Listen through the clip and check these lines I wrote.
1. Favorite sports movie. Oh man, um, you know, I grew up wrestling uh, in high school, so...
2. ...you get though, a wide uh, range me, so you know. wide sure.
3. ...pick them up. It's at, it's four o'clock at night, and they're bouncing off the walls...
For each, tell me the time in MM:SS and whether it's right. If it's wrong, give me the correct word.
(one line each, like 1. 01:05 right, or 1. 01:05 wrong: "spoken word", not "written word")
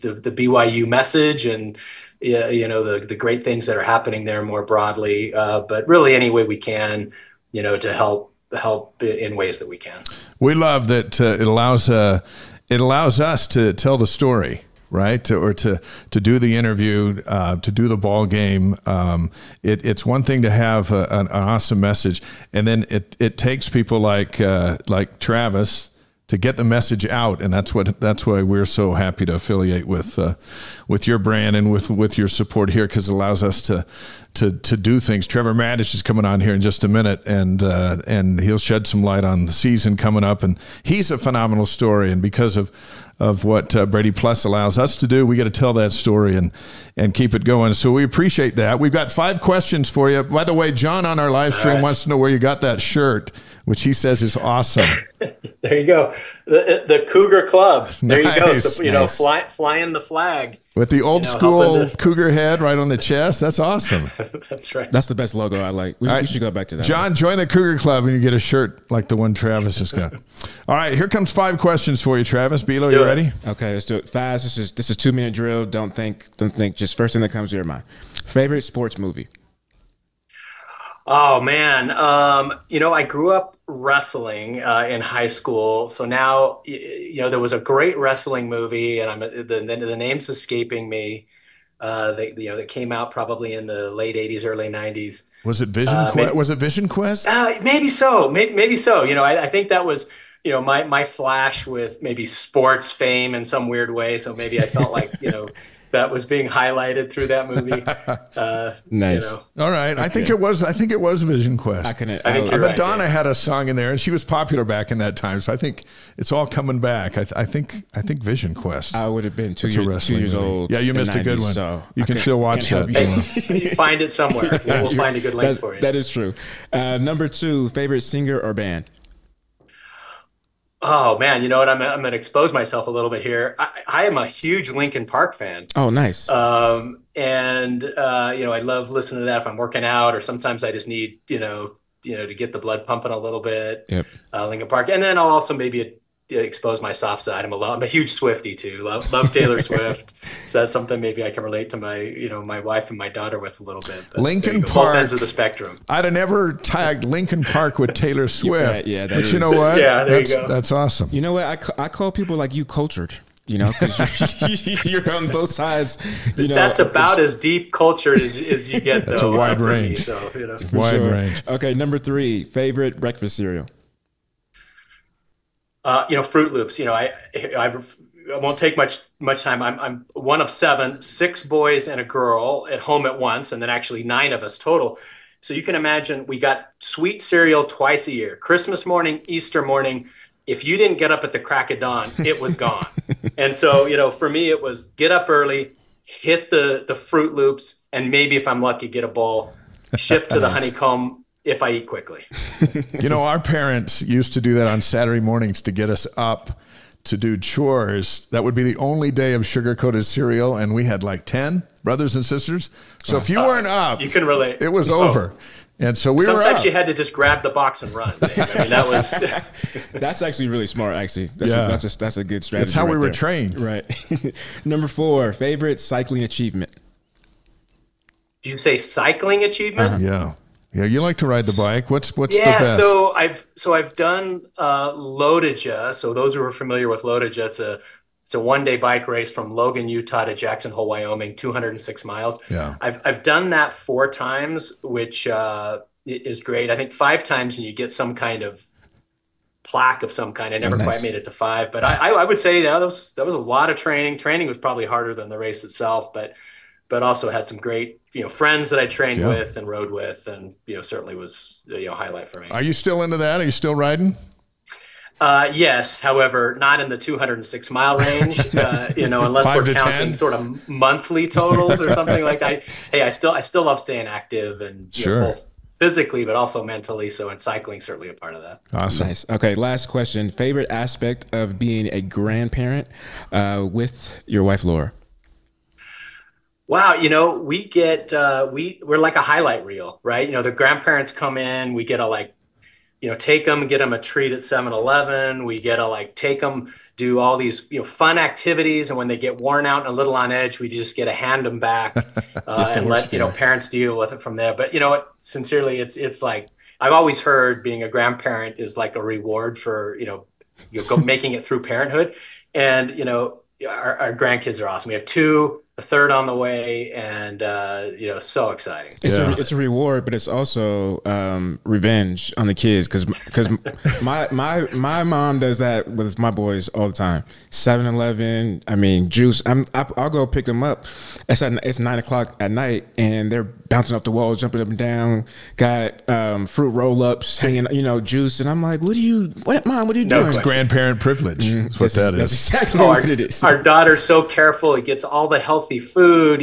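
1. 01:18 right
2. 02:48 right
3. 05:30 wrong: "nine", not "four".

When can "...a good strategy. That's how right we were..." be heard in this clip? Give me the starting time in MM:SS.
03:42.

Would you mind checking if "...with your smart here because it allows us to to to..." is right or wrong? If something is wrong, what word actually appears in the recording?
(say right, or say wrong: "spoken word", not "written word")
wrong: "support", not "smart".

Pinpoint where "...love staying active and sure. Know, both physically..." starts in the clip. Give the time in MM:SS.
04:33.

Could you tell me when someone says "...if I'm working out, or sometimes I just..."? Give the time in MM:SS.
02:19.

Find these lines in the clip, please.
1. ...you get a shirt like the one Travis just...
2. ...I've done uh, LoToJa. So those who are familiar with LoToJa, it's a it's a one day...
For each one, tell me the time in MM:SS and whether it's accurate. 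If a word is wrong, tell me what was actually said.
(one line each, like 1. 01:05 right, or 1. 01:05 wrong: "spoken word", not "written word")
1. 01:08 right
2. 03:53 right.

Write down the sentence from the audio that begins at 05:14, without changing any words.
We have two a third on the way, and uh, you know, so exciting.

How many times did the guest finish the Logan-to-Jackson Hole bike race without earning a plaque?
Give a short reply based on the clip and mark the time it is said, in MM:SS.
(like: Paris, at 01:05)
4, at 04:03.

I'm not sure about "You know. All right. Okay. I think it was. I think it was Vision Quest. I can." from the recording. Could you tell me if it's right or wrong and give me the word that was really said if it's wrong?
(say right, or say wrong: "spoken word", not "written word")
right.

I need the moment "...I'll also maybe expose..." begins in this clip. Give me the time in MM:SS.
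02:25.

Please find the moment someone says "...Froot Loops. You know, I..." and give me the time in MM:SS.
02:56.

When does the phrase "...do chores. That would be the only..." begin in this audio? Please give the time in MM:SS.
03:27.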